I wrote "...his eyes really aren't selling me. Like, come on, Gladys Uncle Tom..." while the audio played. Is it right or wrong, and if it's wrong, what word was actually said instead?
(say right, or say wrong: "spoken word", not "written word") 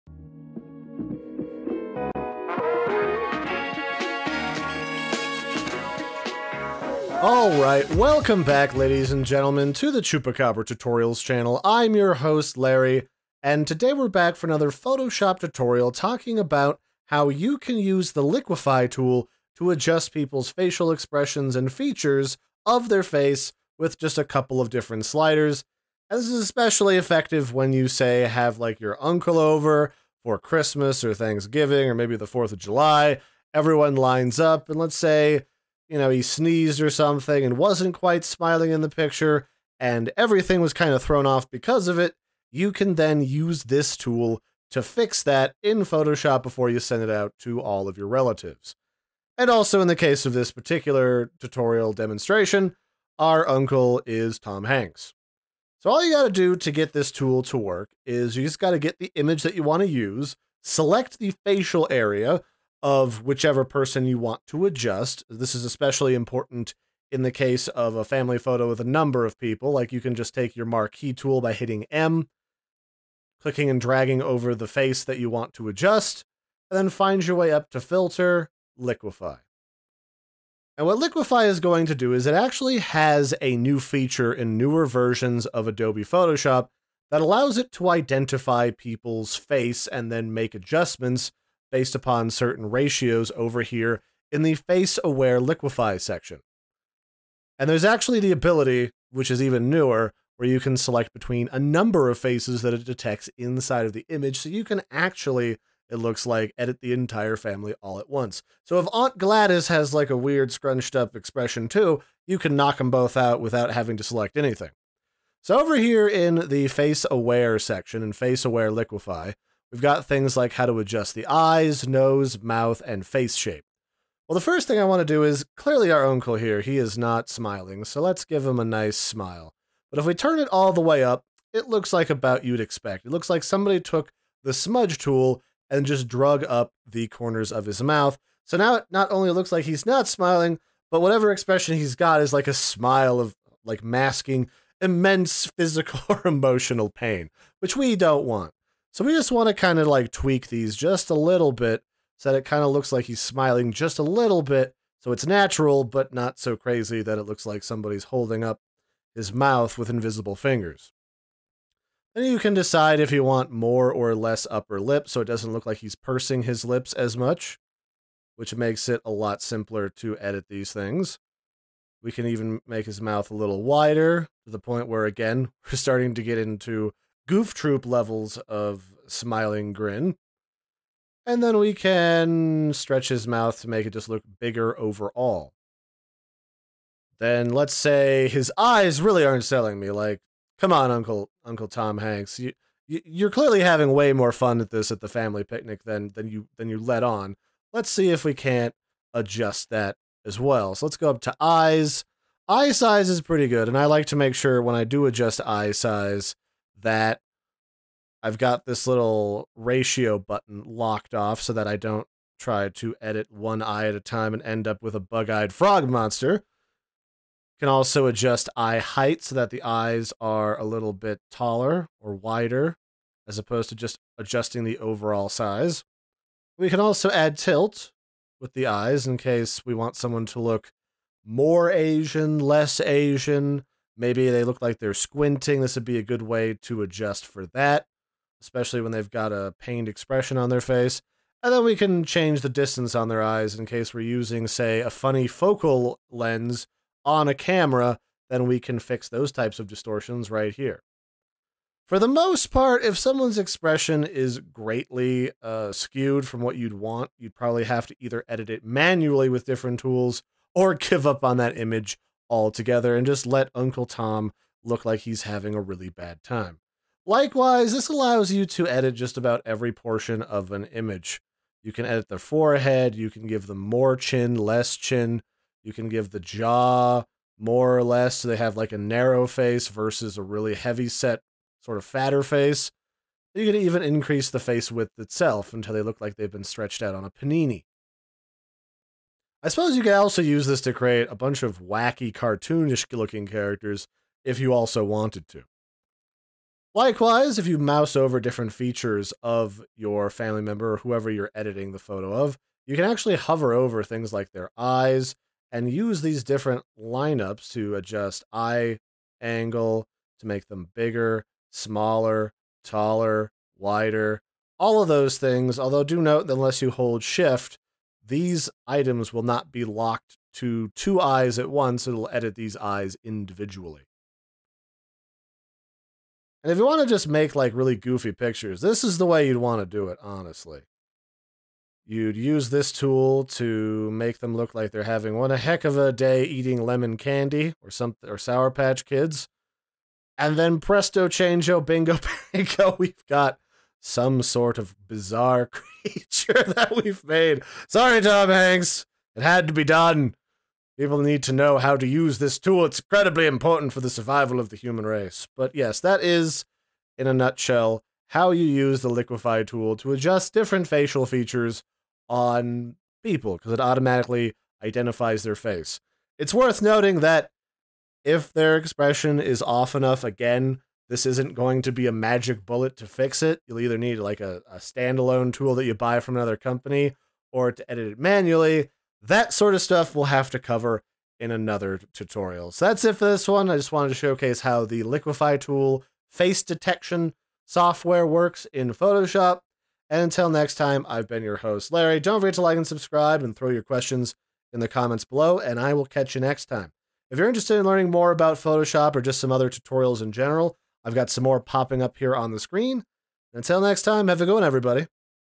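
wrong: "Uncle", not "Gladys".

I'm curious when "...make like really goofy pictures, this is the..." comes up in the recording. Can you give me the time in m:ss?
5:27.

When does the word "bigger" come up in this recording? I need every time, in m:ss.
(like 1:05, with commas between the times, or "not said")
3:04, 5:10.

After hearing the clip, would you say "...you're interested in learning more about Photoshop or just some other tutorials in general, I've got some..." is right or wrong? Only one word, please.
right.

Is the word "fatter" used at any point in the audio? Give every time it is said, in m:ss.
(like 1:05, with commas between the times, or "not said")
4:41.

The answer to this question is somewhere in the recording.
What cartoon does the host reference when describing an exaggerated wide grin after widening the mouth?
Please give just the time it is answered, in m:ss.
2:57.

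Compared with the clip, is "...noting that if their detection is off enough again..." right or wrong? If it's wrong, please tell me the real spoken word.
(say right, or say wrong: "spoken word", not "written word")
wrong: "expression", not "detection".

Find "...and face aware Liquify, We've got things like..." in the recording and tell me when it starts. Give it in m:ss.
1:58.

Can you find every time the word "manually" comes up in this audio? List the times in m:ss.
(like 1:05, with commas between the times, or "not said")
4:18, 6:17.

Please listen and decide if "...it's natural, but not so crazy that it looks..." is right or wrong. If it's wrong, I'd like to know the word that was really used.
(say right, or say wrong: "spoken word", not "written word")
right.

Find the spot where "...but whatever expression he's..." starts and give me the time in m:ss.
2:20.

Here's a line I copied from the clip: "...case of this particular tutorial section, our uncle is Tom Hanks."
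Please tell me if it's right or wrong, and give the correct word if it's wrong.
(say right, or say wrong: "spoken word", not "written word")
wrong: "demonstration", not "section".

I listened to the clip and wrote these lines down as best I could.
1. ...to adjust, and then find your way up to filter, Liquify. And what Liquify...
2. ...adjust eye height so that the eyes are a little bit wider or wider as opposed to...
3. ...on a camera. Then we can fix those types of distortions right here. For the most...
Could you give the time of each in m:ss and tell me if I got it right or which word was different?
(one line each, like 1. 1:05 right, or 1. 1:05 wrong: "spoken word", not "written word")
1. 1:15 right
2. 3:38 wrong: "taller", not "wider"
3. 4:07 right.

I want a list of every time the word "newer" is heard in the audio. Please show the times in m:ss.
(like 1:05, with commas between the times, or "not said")
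1:24, 1:39.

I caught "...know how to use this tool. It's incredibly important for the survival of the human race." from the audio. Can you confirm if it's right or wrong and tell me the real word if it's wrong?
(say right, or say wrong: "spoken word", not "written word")
right.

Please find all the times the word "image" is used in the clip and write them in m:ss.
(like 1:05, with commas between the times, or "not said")
0:59, 1:44, 4:21, 4:30.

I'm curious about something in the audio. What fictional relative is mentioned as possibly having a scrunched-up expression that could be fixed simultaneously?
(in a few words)
Aunt Gladys.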